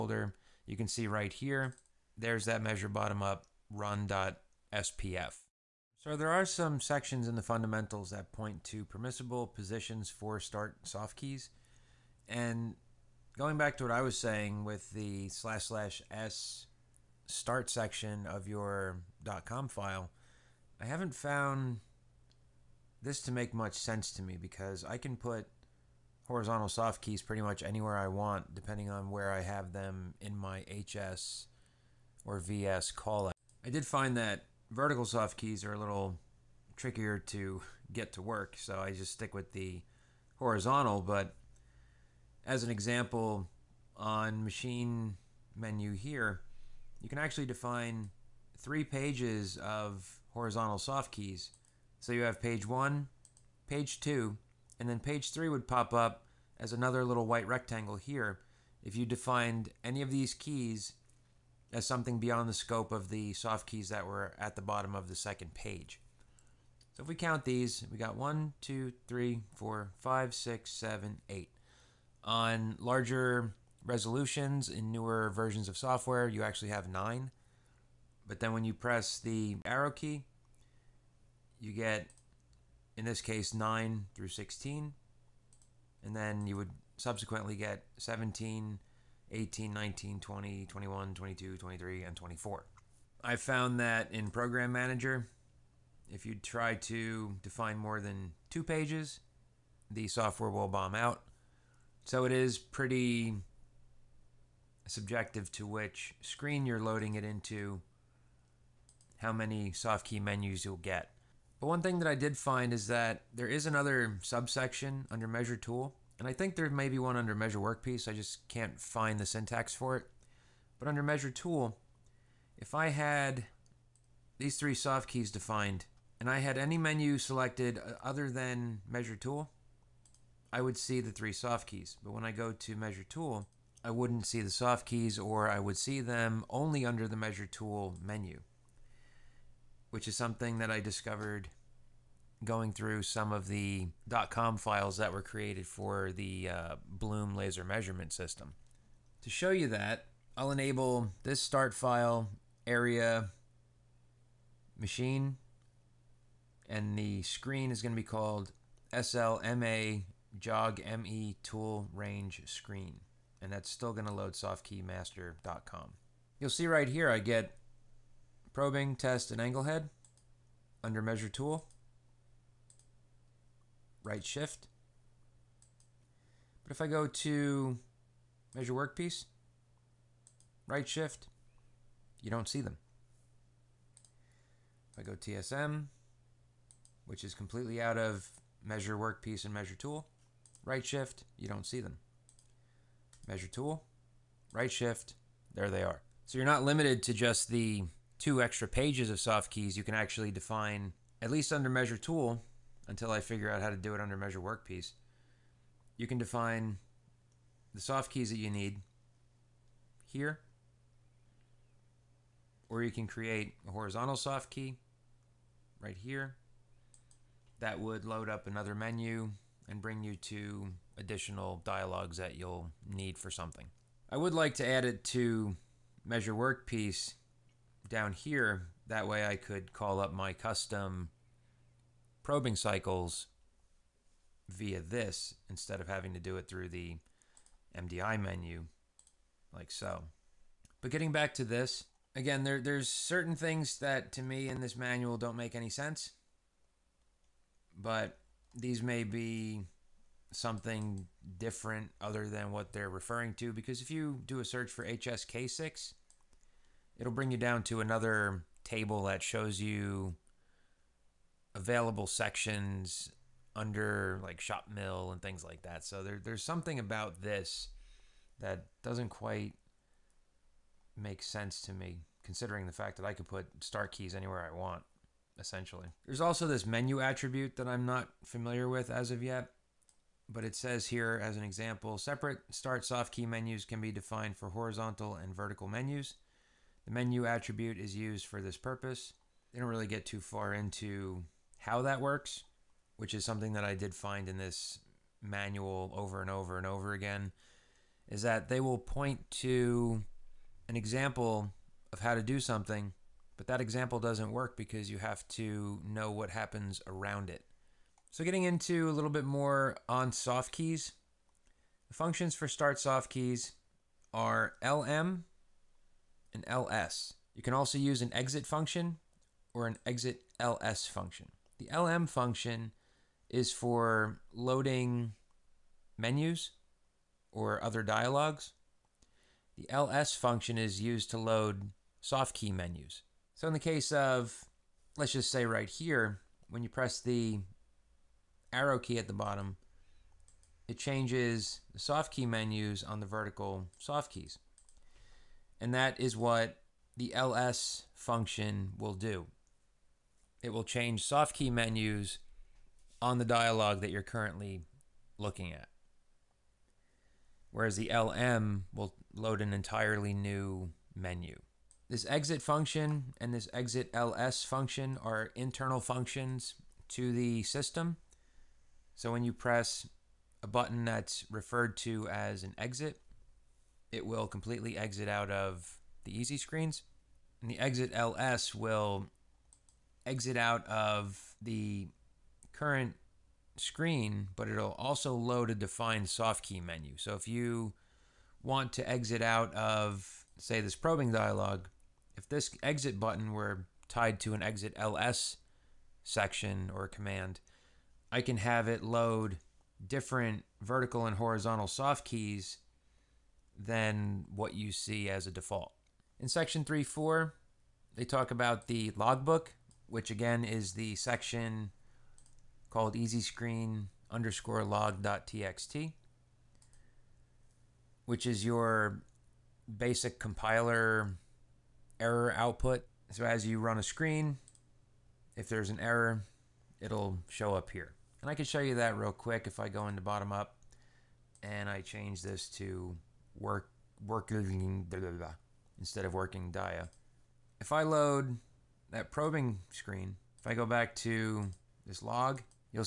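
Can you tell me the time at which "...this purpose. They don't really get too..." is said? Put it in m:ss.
4:48.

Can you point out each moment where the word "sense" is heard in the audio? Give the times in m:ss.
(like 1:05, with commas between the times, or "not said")
0:23, 4:05, 4:31.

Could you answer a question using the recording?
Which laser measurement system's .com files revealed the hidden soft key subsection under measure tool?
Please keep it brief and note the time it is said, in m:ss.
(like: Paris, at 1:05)
Blum, at 2:26.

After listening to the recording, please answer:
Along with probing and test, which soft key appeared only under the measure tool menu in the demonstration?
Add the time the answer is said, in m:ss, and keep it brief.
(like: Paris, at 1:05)
angle head, at 2:49.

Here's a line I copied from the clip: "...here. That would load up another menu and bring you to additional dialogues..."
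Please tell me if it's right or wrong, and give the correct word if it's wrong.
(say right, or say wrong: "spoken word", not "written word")
right.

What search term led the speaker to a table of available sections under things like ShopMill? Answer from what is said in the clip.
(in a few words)
HSK6.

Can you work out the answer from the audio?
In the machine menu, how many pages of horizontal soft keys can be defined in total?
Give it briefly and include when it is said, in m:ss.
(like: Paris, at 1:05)
3, at 0:48.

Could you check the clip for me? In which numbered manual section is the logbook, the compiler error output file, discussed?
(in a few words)
3.4.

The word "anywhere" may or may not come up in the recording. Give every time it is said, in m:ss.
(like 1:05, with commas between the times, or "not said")
0:27, 4:34.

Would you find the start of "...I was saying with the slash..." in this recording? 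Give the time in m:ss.
0:13.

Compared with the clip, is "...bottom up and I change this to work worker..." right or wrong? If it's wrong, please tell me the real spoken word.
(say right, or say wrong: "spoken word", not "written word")
right.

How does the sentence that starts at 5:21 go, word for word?
The lm function is for loading menus or other dialogues.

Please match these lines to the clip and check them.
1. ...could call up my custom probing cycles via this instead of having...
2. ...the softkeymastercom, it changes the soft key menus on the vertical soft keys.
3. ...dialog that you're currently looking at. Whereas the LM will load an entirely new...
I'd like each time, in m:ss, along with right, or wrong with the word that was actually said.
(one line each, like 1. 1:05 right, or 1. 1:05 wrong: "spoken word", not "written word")
1. 3:49 right
2. 5:39 wrong: "bottom", not "softkeymastercom"
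3. 5:53 right.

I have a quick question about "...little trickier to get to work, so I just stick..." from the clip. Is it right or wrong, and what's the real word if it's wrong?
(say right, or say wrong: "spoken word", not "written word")
right.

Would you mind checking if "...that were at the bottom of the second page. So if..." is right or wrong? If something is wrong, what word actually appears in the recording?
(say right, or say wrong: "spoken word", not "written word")
right.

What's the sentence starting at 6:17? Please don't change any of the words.
And the exit LS will exit out of the current screen, but it'll also load a defined soft key menu.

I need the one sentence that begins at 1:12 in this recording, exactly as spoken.
On larger resolutions in newer versions of software, you actually have nine.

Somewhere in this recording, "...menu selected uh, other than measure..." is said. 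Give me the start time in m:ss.
2:06.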